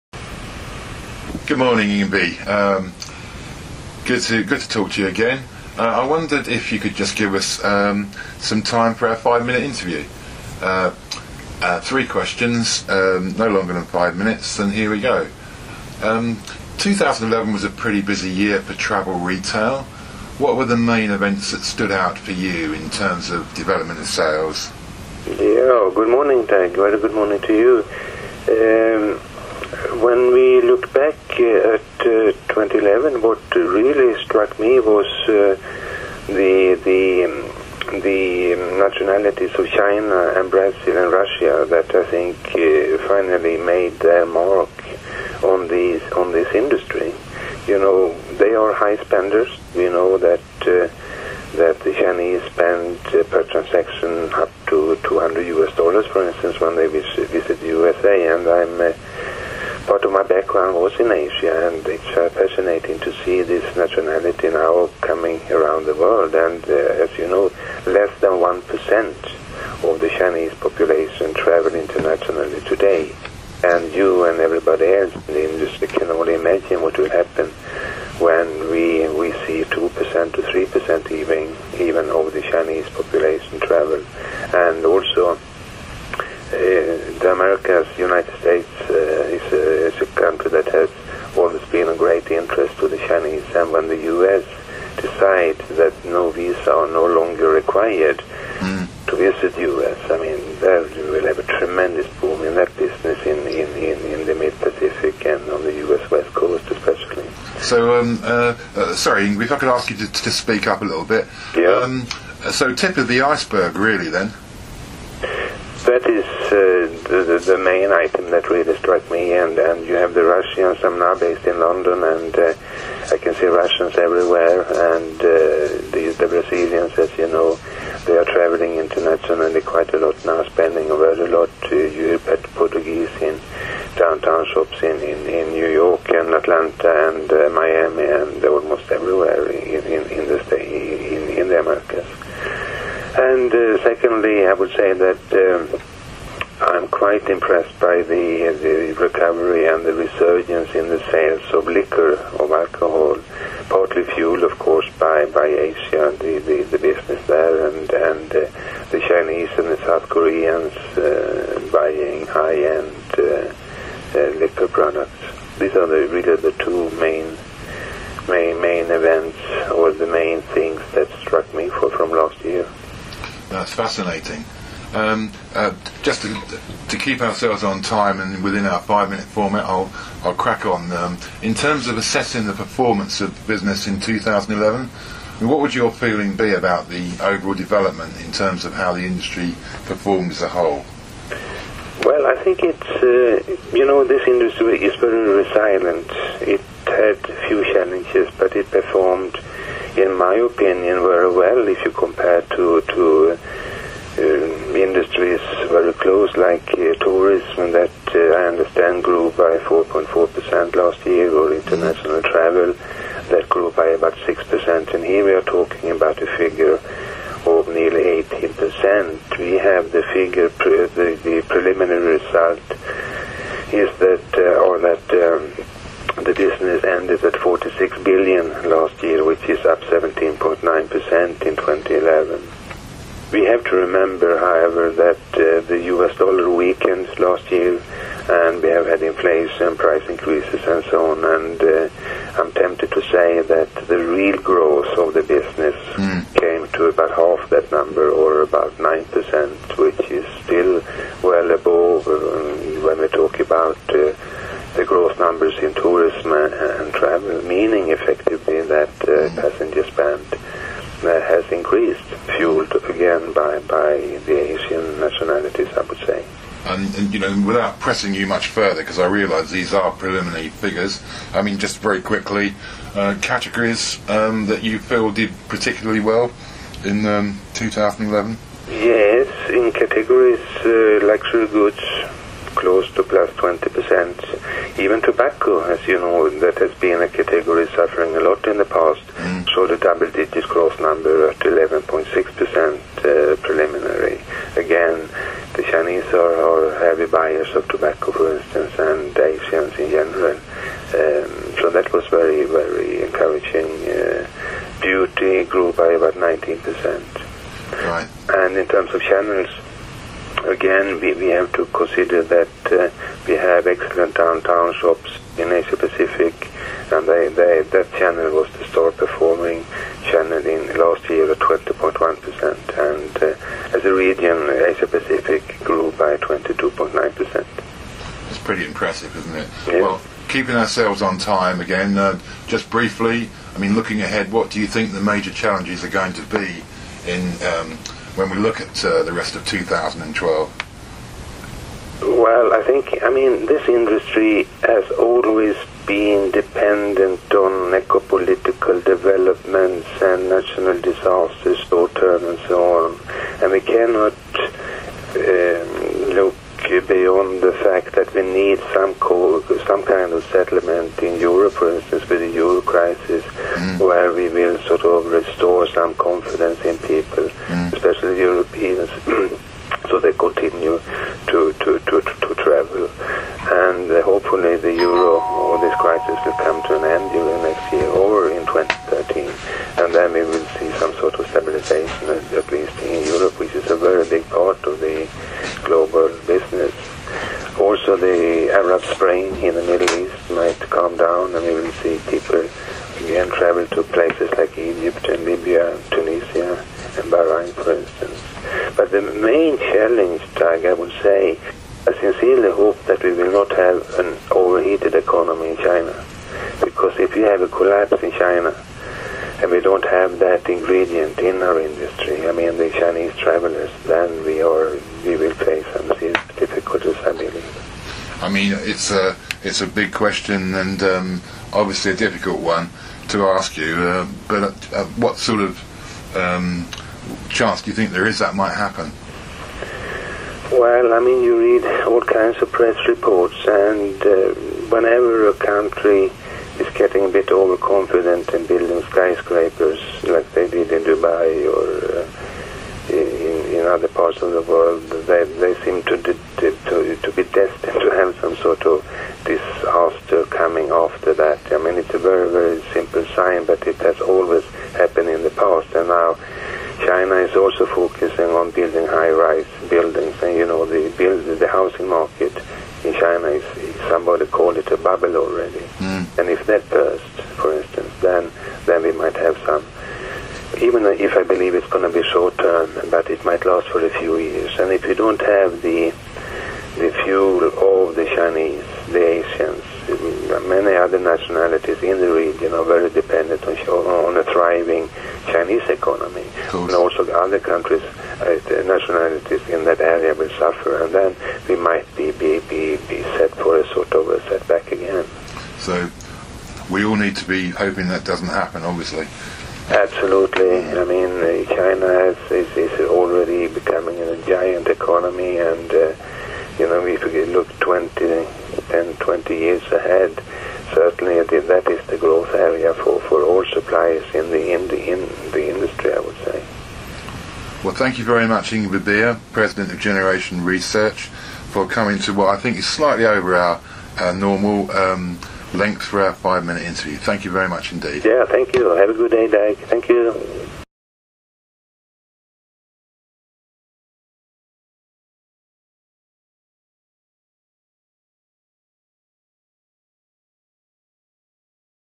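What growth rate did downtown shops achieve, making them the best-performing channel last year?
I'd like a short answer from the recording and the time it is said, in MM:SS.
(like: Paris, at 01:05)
20.1%, at 05:21.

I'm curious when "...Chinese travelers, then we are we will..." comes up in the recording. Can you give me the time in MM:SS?
06:52.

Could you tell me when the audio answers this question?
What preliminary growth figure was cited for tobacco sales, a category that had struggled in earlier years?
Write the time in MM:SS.
04:51.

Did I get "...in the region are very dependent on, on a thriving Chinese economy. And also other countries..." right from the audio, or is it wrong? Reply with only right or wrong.
right.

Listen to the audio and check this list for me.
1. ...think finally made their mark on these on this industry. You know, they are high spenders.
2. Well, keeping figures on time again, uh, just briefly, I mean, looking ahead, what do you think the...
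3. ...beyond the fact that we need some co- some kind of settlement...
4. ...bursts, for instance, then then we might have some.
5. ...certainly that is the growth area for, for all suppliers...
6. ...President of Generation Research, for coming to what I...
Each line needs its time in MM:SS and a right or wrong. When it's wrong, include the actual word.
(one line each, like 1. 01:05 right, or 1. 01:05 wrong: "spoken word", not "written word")
1. 00:42 right
2. 05:29 wrong: "ourselves", not "figures"
3. 05:56 right
4. 07:46 right
5. 08:30 right
6. 08:39 right.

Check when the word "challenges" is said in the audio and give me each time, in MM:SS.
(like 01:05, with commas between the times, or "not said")
03:17, 05:35, 06:39.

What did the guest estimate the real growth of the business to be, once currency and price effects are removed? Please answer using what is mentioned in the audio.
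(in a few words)
About 9%.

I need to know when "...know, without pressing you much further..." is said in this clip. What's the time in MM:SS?
04:27.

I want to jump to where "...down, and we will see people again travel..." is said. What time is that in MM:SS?
06:30.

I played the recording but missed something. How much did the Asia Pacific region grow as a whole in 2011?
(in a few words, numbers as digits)
22.9%.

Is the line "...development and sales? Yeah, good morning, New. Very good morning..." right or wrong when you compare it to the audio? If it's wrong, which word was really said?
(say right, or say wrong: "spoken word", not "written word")
wrong: "Tag", not "New".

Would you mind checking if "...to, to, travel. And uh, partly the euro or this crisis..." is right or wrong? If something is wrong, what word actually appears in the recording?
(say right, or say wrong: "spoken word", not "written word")
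wrong: "hopefully", not "partly".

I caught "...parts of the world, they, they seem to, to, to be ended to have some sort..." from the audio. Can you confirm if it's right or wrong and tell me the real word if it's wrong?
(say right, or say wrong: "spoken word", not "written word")
wrong: "destined", not "ended".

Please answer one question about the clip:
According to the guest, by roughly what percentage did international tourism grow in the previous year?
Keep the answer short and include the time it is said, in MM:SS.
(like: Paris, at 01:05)
4.4%, at 03:29.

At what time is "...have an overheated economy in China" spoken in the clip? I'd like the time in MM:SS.
06:43.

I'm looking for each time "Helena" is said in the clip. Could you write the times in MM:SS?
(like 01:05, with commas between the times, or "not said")
not said.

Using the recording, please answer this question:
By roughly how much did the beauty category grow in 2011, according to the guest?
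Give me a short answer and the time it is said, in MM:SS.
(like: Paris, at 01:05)
About 19%, at 05:05.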